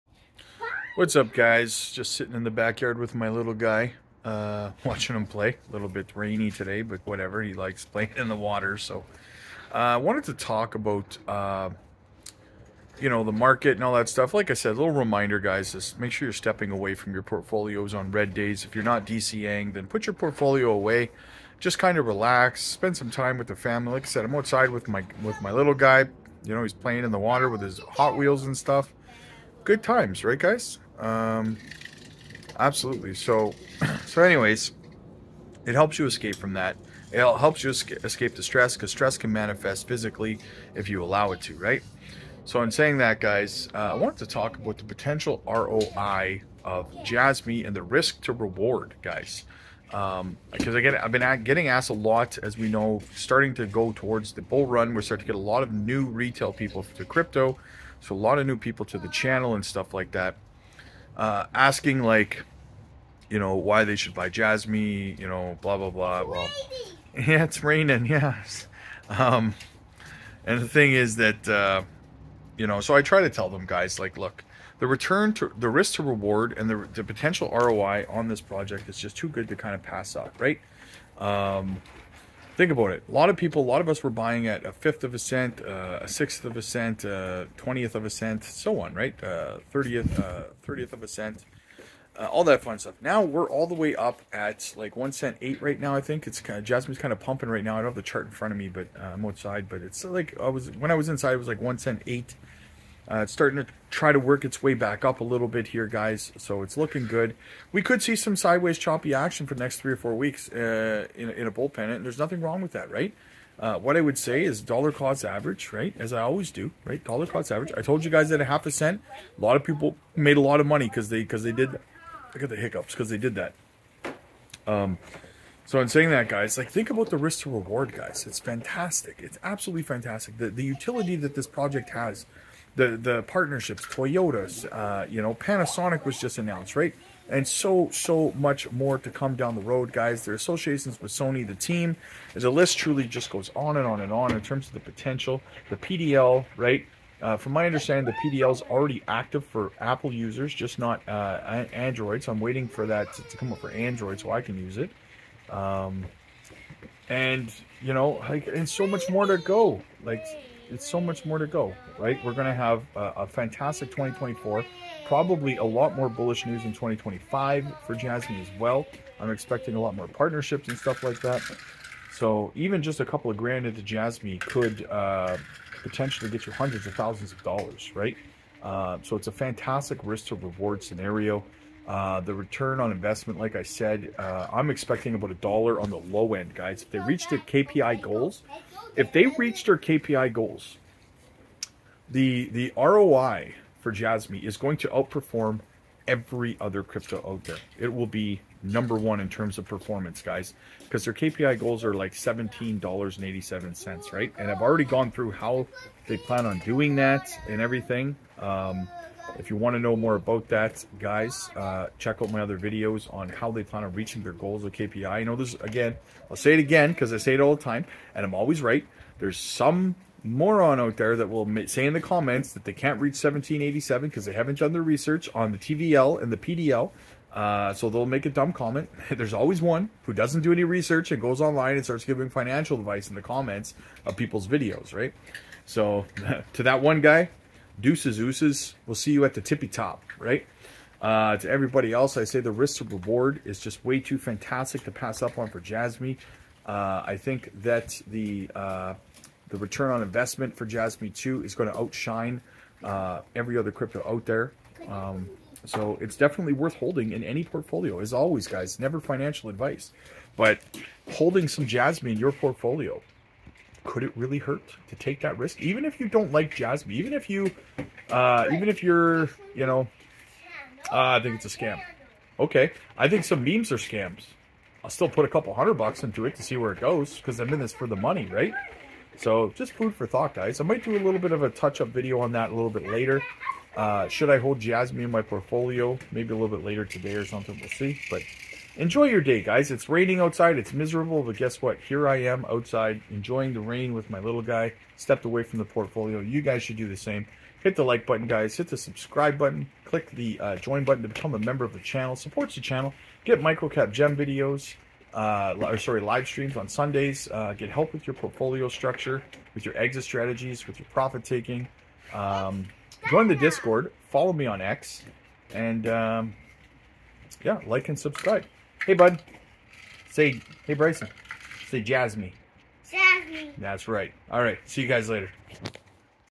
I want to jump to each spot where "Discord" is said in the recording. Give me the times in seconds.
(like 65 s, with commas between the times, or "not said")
313 s.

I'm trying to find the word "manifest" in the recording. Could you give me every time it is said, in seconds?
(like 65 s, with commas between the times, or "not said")
39 s.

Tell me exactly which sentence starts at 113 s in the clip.
Uh, what I would say is dollar cost average, right?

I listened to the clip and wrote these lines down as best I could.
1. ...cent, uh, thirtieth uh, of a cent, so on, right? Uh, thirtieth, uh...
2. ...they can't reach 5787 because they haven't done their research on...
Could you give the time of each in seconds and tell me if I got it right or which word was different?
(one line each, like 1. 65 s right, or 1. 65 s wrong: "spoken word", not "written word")
1. 86 s wrong: "twentieth", not "thirtieth"
2. 222 s wrong: "1787", not "5787".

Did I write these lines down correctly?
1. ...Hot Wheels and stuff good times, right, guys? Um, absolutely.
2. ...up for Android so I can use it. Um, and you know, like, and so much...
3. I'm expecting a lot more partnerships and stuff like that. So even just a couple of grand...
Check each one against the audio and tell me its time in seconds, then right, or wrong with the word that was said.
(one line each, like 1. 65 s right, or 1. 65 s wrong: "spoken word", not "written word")
1. 27 s right
2. 153 s right
3. 169 s right.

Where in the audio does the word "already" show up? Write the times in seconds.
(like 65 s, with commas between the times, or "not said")
148 s, 204 s.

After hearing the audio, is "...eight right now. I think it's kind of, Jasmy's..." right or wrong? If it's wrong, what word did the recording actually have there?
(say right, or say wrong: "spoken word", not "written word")
right.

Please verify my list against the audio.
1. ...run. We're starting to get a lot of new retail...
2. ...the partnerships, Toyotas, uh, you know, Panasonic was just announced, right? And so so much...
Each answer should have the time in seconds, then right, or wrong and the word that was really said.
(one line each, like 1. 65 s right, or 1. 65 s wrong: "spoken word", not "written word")
1. 54 s right
2. 132 s right.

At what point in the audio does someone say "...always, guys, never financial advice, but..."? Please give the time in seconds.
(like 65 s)
258 s.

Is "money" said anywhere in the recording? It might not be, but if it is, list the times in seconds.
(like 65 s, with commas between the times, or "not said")
120 s, 277 s.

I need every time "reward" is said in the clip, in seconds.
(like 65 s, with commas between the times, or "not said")
48 s, 76 s, 127 s, 180 s, 242 s.